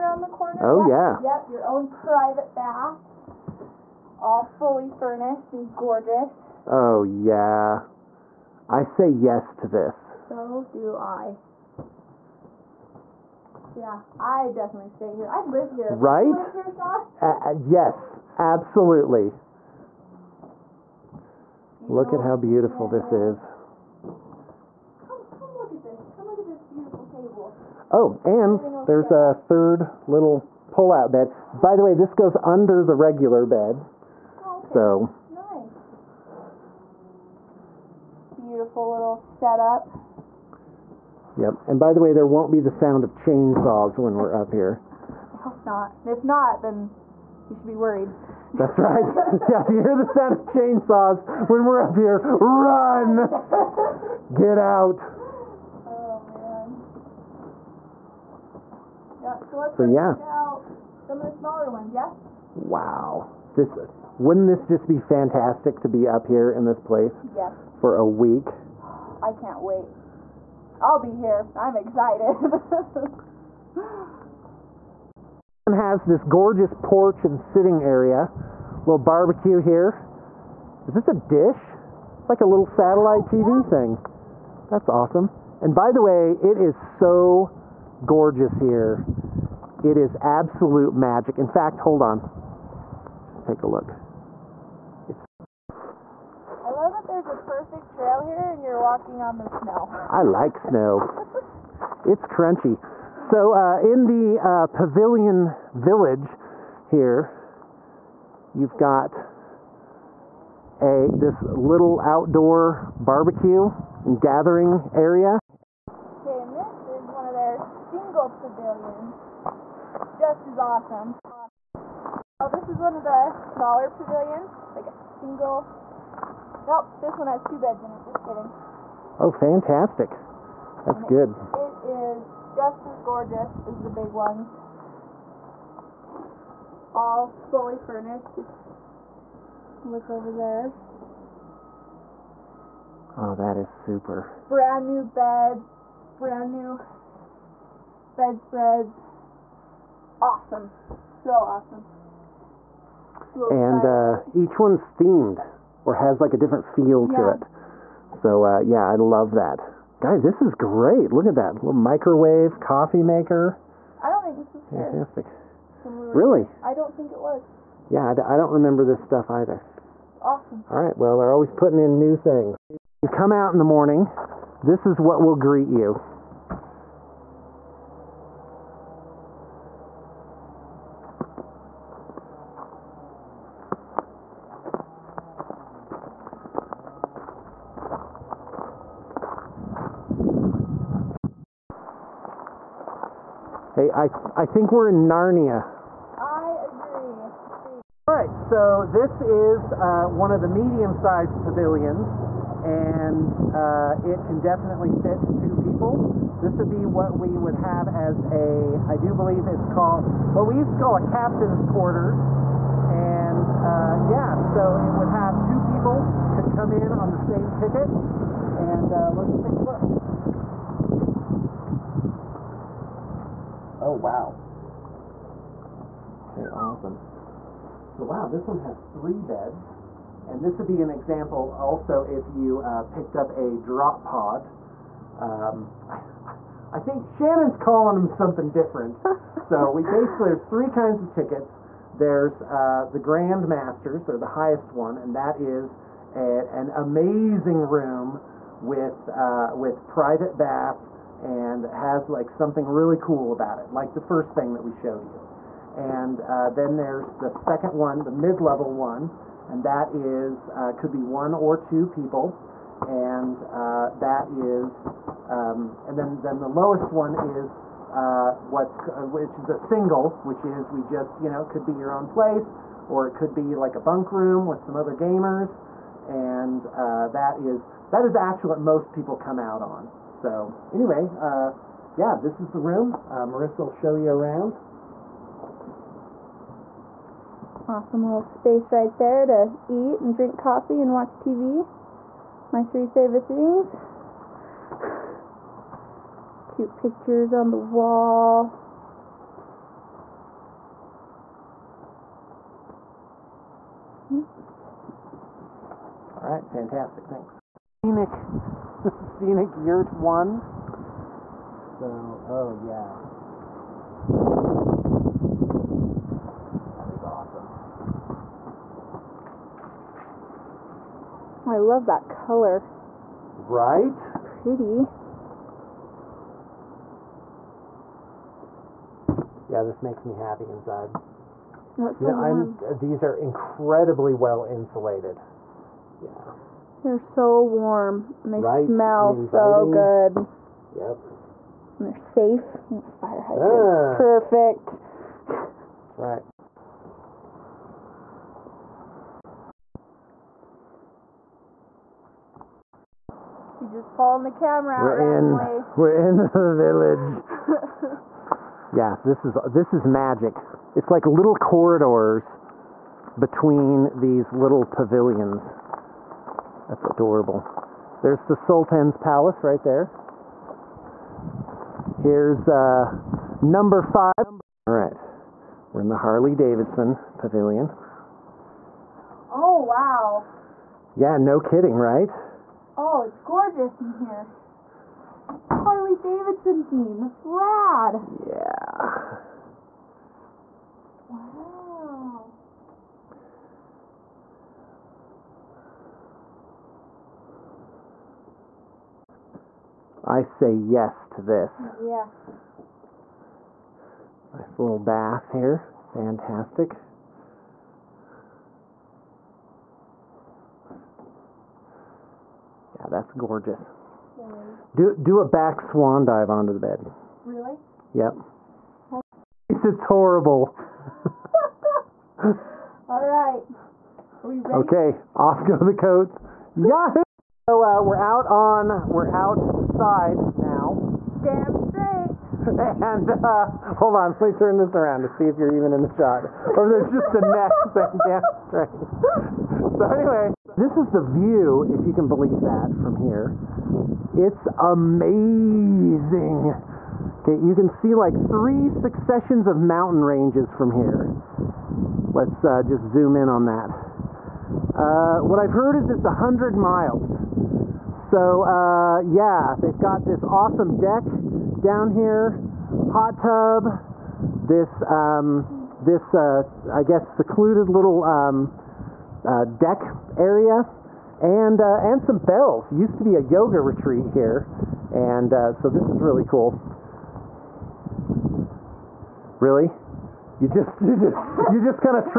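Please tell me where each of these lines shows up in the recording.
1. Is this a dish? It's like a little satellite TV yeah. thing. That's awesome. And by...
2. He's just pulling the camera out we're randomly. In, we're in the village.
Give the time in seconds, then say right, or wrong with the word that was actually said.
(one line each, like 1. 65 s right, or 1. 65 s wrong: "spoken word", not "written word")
1. 80 s right
2. 353 s right.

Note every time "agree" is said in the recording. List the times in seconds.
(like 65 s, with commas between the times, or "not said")
196 s.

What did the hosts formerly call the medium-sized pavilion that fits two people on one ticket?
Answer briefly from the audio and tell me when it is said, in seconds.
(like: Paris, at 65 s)
captain's quarters, at 211 s.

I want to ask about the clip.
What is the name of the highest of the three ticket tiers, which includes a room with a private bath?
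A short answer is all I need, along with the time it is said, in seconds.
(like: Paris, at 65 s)
Grand Masters, at 242 s.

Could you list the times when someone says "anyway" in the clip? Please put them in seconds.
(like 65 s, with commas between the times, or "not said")
280 s, 439 s.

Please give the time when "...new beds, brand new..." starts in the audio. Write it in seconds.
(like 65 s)
144 s.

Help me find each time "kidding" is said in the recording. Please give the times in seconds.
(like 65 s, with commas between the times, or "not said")
128 s, 381 s.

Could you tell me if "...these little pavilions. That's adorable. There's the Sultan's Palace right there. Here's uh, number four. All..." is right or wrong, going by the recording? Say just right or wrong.
wrong.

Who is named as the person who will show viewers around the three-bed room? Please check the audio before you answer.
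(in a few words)
Marissa.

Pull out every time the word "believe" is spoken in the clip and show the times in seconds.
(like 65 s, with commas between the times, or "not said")
209 s, 442 s.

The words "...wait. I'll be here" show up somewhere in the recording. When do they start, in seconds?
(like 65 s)
69 s.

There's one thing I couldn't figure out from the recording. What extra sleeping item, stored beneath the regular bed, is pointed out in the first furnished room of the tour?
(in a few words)
pull-out bed.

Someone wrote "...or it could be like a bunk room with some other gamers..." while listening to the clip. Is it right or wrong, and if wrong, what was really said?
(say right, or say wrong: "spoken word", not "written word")
right.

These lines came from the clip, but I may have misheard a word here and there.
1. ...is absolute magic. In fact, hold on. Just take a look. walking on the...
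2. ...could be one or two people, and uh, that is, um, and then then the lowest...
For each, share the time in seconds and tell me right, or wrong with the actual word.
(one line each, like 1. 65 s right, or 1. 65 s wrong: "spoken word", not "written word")
1. 89 s right
2. 260 s right.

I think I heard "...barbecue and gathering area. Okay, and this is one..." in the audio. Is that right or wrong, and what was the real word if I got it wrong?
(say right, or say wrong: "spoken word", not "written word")
right.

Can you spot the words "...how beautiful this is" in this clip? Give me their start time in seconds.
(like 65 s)
22 s.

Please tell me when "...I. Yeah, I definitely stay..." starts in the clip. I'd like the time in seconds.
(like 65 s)
10 s.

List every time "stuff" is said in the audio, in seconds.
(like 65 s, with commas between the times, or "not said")
168 s.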